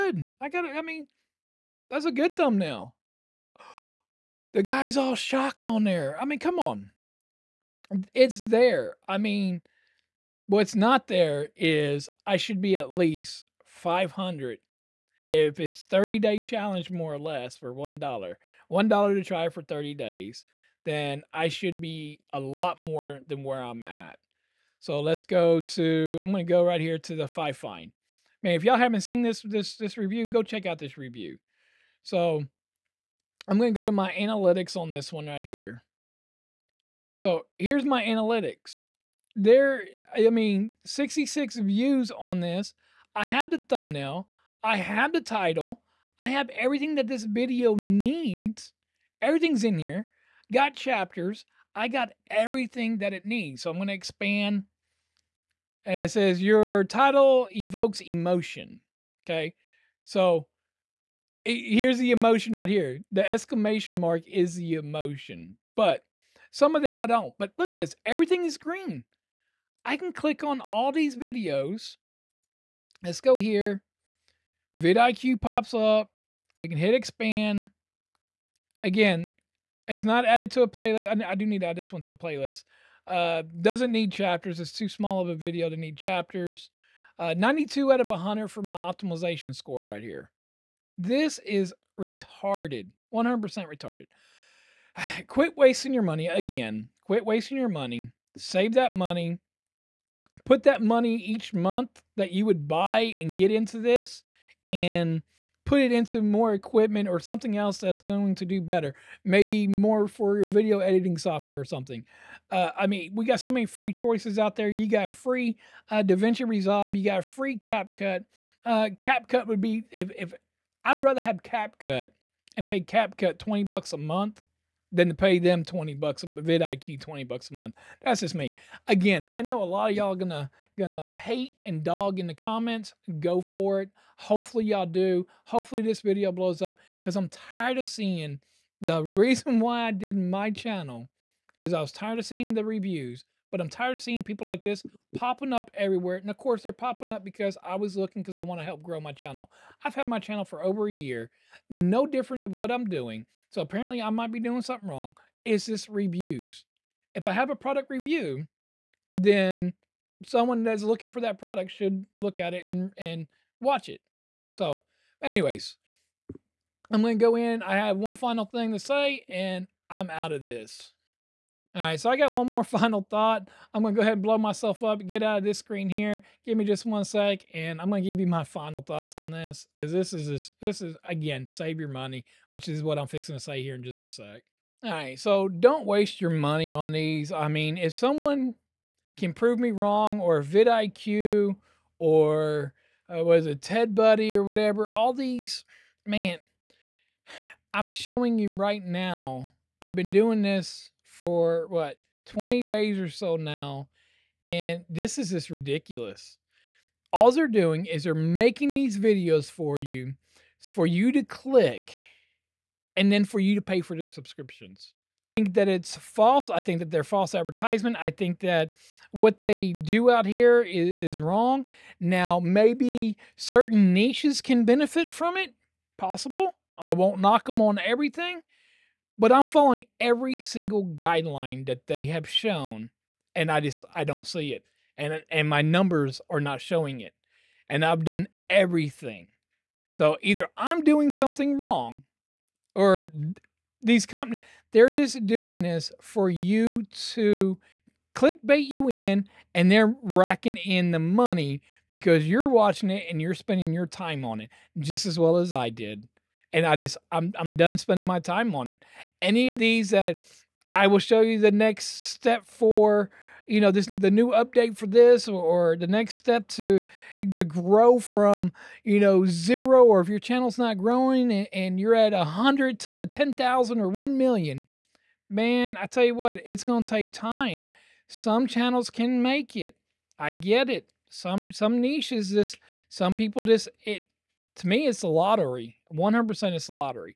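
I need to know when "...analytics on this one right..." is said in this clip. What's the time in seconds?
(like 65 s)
34 s.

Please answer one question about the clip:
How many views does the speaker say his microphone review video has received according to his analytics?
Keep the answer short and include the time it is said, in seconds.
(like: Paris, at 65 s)
66, at 40 s.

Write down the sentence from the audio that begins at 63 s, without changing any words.
The exclamation mark is the emotion, but some of that I don't.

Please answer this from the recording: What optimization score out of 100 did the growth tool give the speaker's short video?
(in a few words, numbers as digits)
92.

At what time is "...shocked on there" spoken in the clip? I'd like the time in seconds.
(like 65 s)
5 s.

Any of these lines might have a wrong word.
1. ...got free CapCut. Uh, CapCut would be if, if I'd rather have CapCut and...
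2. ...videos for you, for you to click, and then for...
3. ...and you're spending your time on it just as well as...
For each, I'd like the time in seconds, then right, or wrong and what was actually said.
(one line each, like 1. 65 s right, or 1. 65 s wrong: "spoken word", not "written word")
1. 117 s right
2. 208 s right
3. 253 s right.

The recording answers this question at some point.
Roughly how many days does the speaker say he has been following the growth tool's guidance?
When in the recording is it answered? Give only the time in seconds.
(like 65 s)
202 s.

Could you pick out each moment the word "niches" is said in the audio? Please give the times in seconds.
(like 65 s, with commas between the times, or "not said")
223 s, 281 s.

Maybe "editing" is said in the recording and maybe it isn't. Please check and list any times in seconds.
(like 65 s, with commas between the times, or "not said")
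110 s.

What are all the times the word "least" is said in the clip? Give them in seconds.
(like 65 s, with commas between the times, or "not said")
12 s.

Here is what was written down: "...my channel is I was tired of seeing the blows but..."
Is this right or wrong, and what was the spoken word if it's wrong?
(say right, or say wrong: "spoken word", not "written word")
wrong: "reviews", not "blows".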